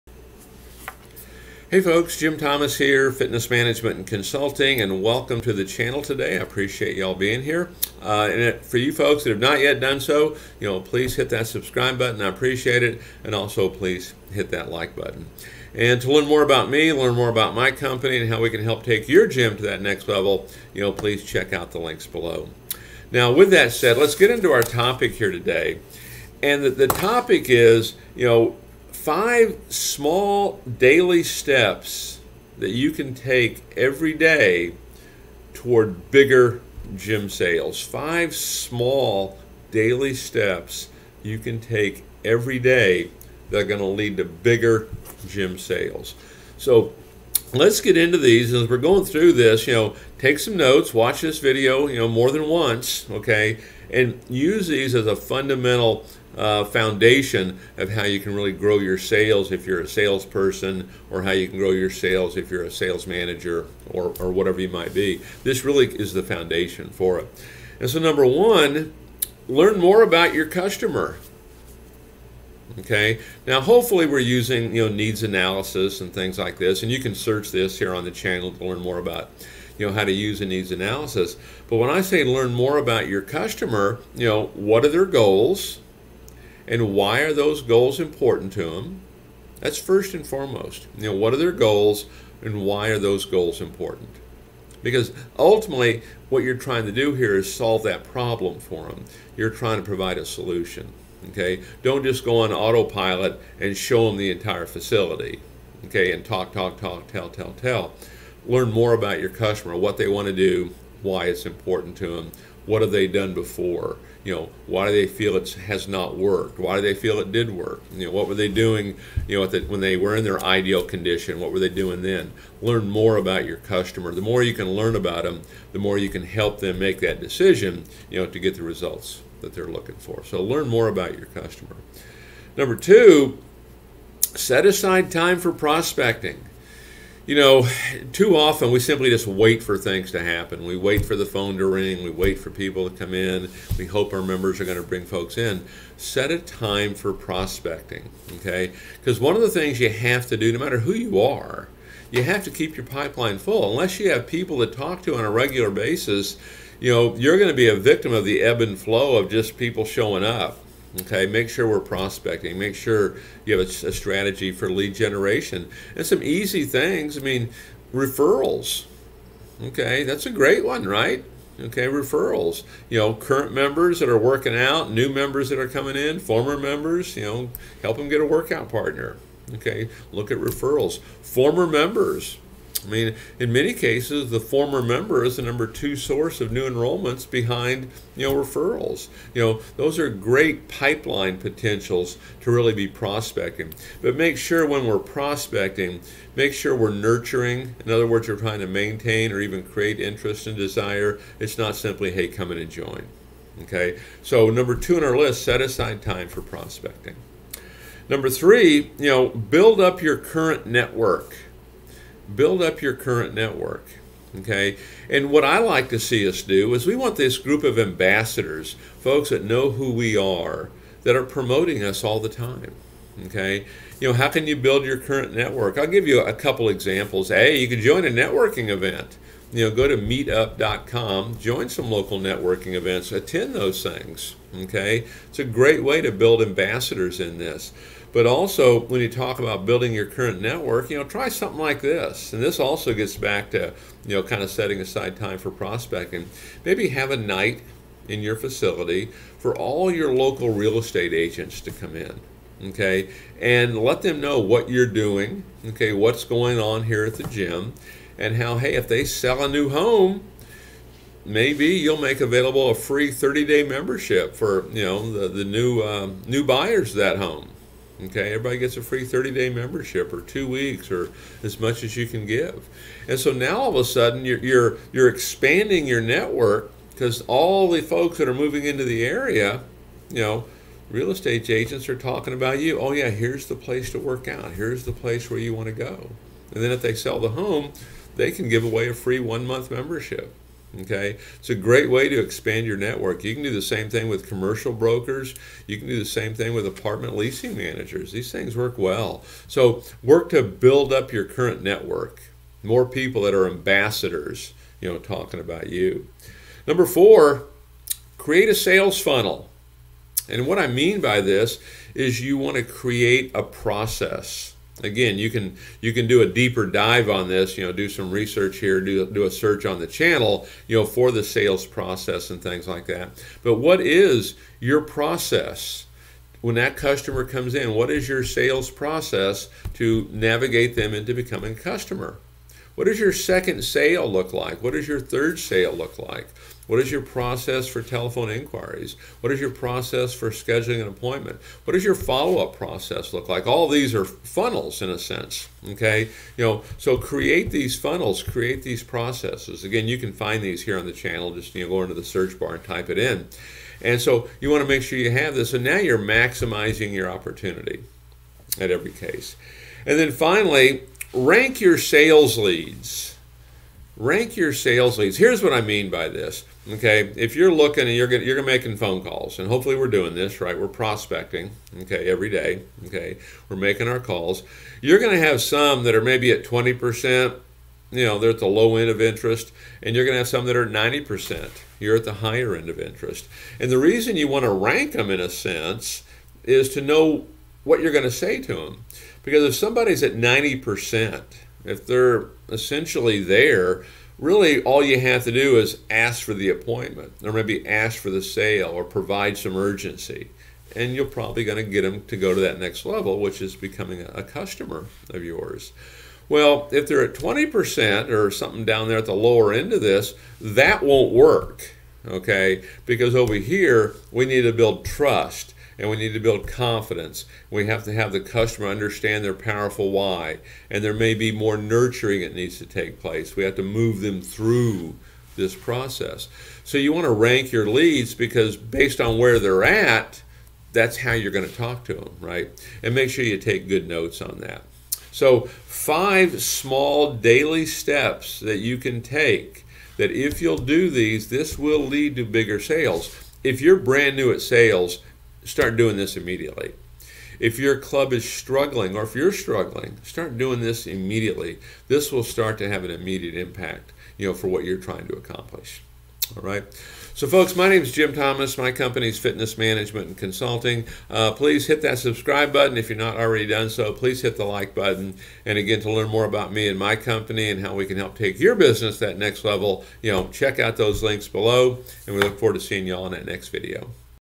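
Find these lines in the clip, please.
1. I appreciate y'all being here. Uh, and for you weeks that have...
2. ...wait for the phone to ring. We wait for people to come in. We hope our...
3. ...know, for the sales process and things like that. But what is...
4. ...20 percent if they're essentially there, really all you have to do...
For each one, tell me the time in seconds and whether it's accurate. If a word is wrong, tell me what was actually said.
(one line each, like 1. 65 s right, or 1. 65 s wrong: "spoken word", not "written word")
1. 6 s wrong: "folks", not "weeks"
2. 140 s right
3. 320 s right
4. 390 s wrong: "90", not "20".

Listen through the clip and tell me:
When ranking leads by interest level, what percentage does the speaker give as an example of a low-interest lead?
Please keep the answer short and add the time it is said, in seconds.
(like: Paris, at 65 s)
20 percent, at 376 s.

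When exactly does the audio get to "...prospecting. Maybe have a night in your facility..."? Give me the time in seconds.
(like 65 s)
245 s.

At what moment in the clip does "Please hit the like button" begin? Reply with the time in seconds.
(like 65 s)
463 s.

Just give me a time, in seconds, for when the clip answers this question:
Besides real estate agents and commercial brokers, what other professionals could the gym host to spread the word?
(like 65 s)
296 s.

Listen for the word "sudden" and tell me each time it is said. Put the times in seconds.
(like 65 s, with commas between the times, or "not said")
273 s.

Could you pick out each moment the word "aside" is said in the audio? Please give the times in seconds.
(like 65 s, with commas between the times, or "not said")
134 s, 205 s, 244 s.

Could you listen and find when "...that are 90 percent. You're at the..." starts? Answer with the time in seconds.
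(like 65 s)
380 s.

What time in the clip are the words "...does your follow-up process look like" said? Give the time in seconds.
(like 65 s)
341 s.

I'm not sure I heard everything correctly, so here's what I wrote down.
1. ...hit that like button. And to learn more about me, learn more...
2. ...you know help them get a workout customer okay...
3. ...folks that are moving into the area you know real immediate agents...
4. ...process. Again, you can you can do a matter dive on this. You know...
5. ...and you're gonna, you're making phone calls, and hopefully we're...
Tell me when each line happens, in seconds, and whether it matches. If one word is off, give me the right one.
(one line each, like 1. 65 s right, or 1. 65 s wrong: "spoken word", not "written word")
1. 14 s right
2. 177 s wrong: "partner", not "customer"
3. 277 s wrong: "estate", not "immediate"
4. 313 s wrong: "deeper", not "matter"
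5. 367 s right.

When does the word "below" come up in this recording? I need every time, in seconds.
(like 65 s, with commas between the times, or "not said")
22 s, 471 s.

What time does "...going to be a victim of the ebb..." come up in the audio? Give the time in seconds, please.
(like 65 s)
157 s.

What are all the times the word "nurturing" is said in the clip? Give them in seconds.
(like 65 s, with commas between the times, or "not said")
196 s, 421 s.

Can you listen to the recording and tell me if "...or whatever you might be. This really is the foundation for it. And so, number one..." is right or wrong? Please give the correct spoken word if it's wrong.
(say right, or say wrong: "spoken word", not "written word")
right.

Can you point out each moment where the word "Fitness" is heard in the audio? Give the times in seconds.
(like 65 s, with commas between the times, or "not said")
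3 s, 459 s.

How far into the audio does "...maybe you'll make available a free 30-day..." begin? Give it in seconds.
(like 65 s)
261 s.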